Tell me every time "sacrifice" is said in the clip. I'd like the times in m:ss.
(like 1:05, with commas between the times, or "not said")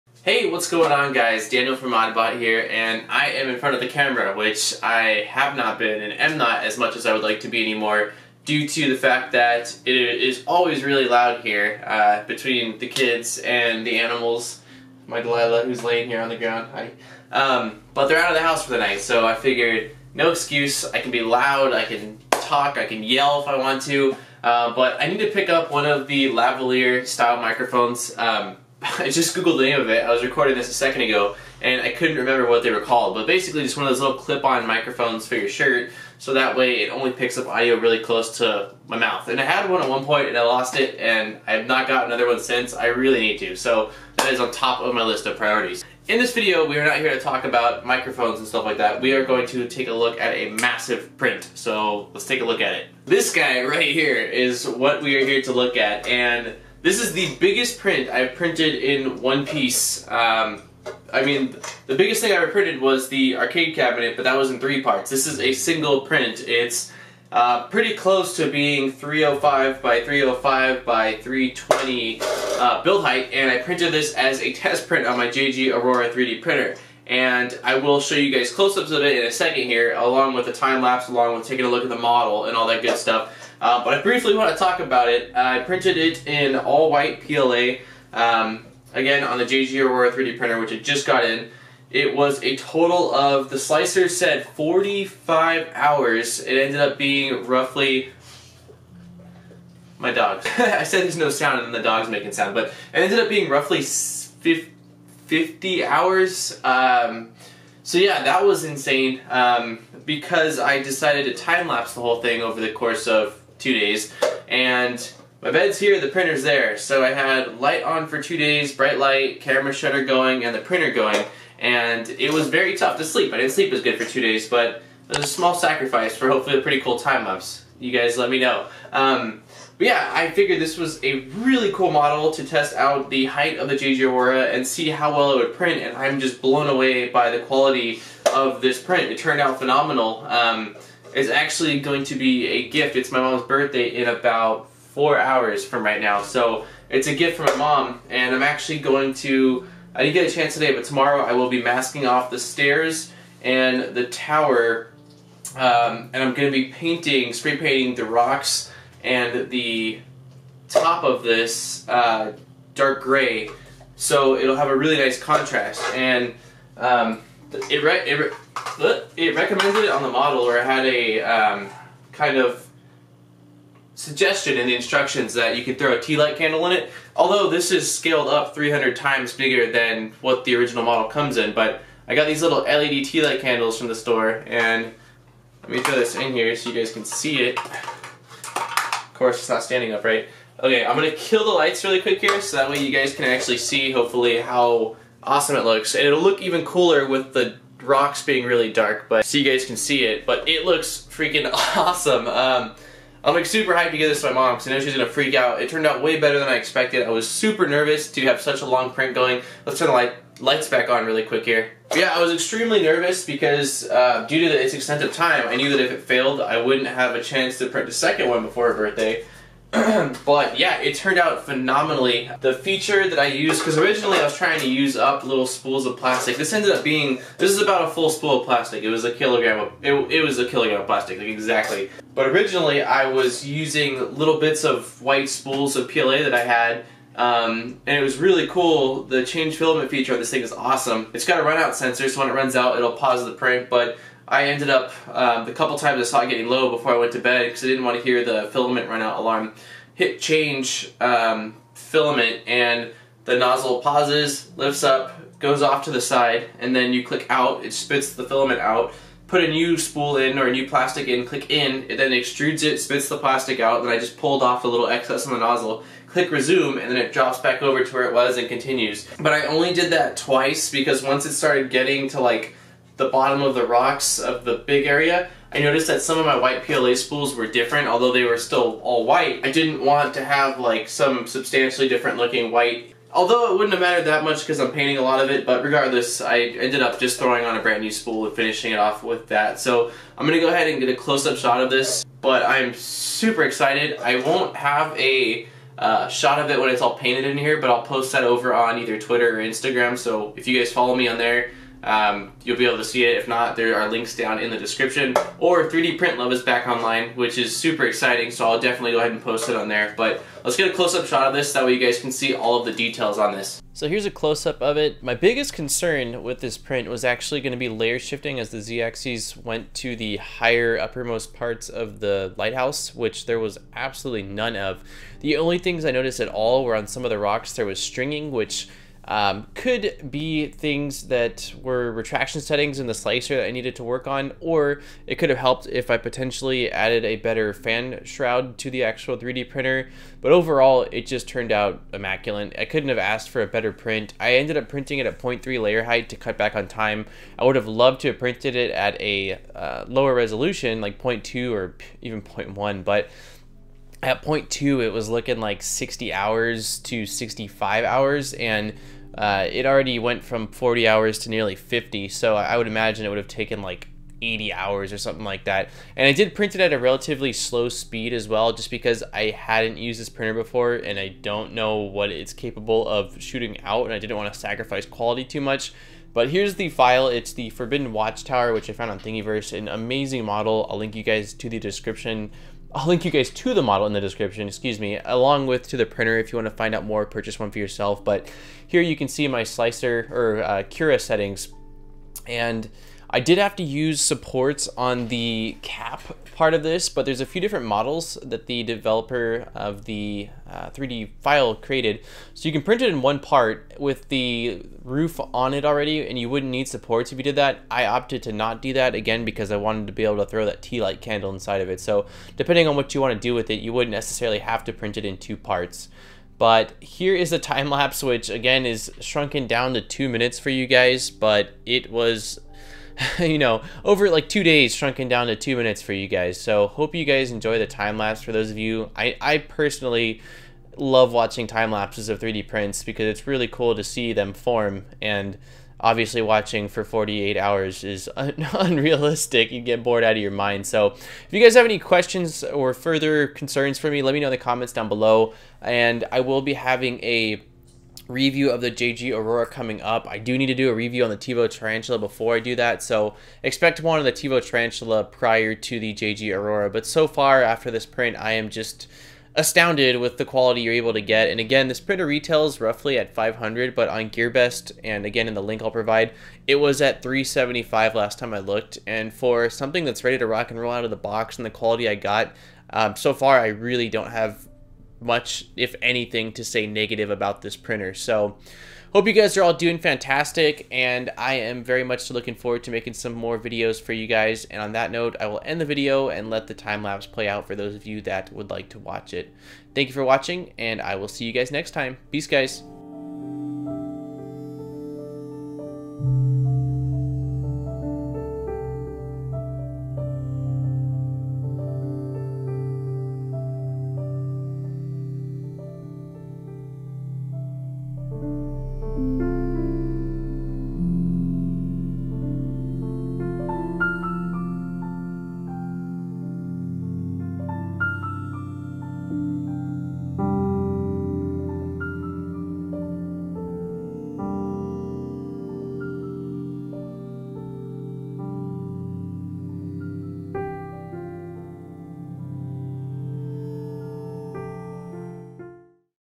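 2:05, 6:14.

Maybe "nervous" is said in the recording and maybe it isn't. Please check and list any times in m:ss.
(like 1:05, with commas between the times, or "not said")
3:27, 3:32.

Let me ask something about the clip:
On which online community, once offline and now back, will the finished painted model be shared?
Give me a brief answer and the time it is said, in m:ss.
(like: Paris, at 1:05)
3D Print Love, at 5:05.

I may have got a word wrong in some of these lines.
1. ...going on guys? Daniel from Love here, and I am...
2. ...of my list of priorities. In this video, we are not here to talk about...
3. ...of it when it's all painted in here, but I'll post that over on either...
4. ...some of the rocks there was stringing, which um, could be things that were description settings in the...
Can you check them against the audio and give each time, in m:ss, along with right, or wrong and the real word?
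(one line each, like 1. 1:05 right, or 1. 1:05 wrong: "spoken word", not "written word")
1. 0:00 wrong: "ModBot", not "Love"
2. 0:44 right
3. 4:56 right
4. 5:26 wrong: "retraction", not "description".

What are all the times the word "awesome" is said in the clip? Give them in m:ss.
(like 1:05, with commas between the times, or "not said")
3:15, 3:21, 4:00.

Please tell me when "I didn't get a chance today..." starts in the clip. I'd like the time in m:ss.
2:29.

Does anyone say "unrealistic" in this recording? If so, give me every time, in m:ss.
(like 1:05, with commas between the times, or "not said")
7:18.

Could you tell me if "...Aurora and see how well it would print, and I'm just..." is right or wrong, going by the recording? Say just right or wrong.
right.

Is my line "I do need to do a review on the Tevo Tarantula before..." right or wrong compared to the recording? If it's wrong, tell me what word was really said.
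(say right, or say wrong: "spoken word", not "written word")
right.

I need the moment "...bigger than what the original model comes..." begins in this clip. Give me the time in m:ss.
2:59.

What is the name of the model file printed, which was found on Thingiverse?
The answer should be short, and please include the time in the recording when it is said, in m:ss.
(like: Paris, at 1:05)
Forbidden Watchtower, at 6:17.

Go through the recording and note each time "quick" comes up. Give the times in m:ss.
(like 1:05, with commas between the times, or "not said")
3:12, 3:31.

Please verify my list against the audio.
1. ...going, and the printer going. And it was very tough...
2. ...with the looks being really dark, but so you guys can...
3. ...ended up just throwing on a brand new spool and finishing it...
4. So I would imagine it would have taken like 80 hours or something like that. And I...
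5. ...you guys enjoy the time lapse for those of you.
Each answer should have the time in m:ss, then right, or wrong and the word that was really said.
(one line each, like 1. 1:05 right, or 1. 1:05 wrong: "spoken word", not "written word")
1. 2:00 right
2. 3:17 wrong: "rocks", not "looks"
3. 4:46 right
4. 6:02 right
5. 7:06 right.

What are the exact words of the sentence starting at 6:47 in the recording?
I opted to not do that, again, because I wanted to be able to throw that tea light candle inside of it.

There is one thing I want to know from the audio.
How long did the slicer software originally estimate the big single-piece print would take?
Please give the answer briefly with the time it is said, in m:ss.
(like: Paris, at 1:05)
45 hours, at 1:34.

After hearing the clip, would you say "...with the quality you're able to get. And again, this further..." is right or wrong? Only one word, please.
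wrong.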